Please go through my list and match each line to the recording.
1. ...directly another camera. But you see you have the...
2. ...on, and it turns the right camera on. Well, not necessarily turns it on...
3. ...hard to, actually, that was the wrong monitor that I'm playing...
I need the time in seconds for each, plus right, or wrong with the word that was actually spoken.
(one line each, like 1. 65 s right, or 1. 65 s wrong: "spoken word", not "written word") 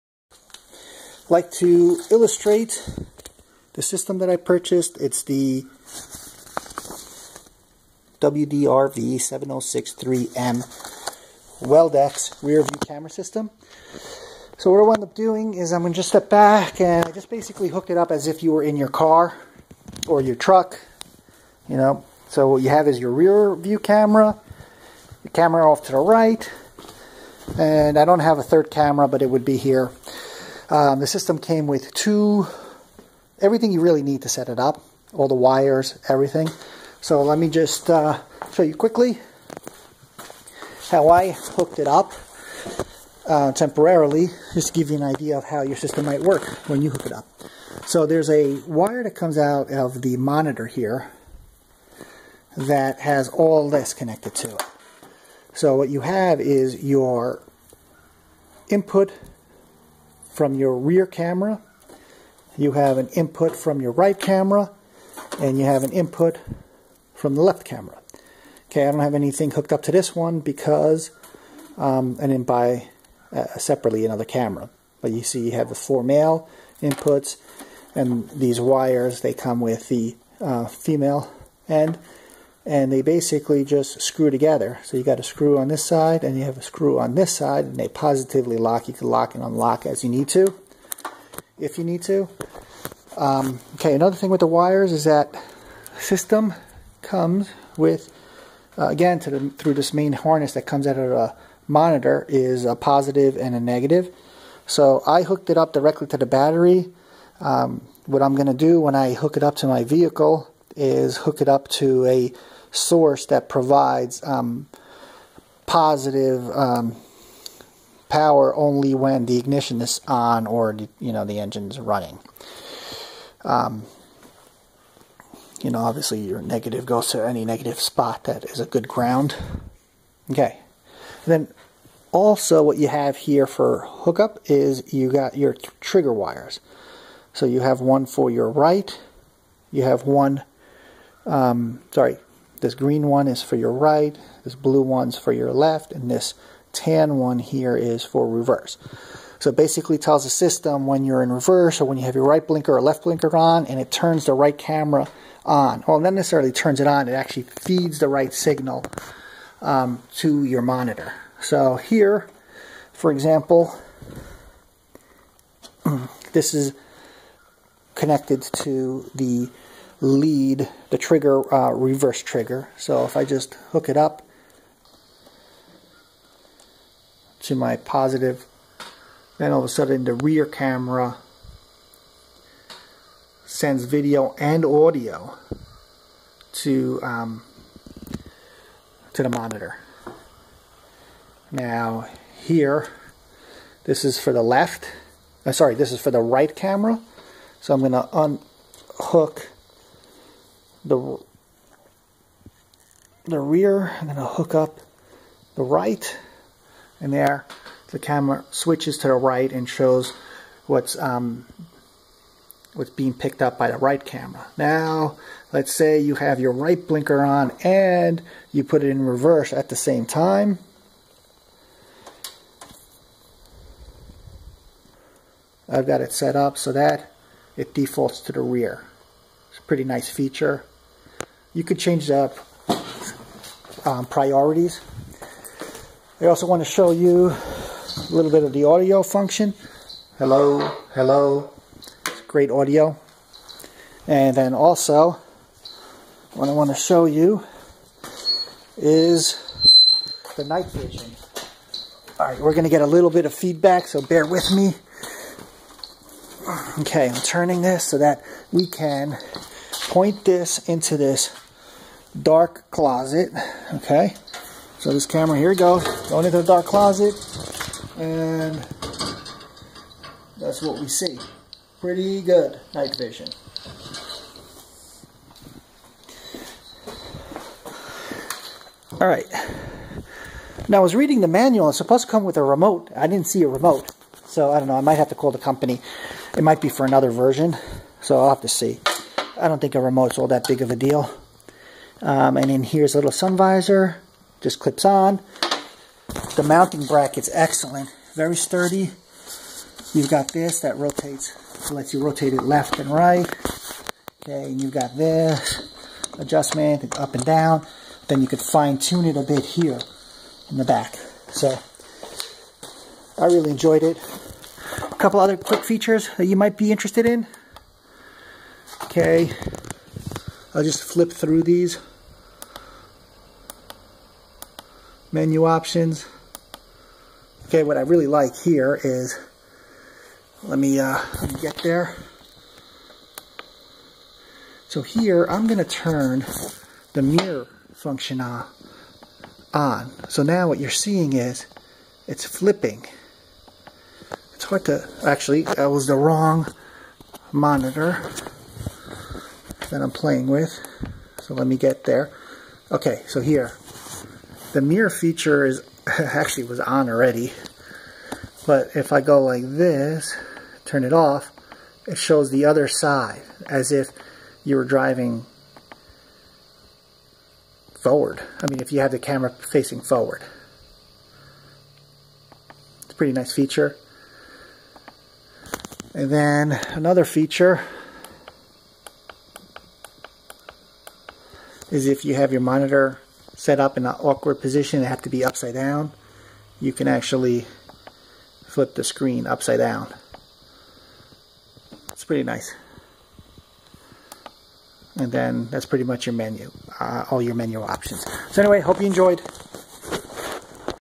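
1. 73 s wrong: "separately", not "directly"
2. 153 s right
3. 344 s right.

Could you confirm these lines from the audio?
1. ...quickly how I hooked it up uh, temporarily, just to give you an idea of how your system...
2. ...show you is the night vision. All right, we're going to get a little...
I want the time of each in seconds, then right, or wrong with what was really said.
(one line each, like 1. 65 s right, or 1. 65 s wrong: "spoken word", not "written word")
1. 38 s right
2. 246 s right.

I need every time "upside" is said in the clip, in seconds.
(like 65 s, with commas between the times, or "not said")
385 s, 389 s.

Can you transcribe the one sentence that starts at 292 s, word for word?
Um, and then here's a little sun visor, just clips on.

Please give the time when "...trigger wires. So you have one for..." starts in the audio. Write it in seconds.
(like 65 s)
135 s.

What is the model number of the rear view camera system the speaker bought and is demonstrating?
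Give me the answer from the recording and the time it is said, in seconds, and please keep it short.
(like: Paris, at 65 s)
WDRV7063M, at 8 s.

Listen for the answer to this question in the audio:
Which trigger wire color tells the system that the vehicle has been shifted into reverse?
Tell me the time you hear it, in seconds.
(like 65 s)
146 s.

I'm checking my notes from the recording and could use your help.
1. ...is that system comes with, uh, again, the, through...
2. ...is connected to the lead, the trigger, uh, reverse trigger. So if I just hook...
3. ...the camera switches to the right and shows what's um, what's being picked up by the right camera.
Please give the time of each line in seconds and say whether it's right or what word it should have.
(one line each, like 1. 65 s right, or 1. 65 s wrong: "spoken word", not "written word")
1. 94 s right
2. 166 s right
3. 207 s right.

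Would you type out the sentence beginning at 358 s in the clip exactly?
But if I go like this, turn it off, it shows the other side as if you were driving forward.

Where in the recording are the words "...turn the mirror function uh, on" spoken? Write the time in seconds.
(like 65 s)
335 s.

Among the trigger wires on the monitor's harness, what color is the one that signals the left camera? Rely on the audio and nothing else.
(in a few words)
Blue.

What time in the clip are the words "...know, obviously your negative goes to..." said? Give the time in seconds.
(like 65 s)
125 s.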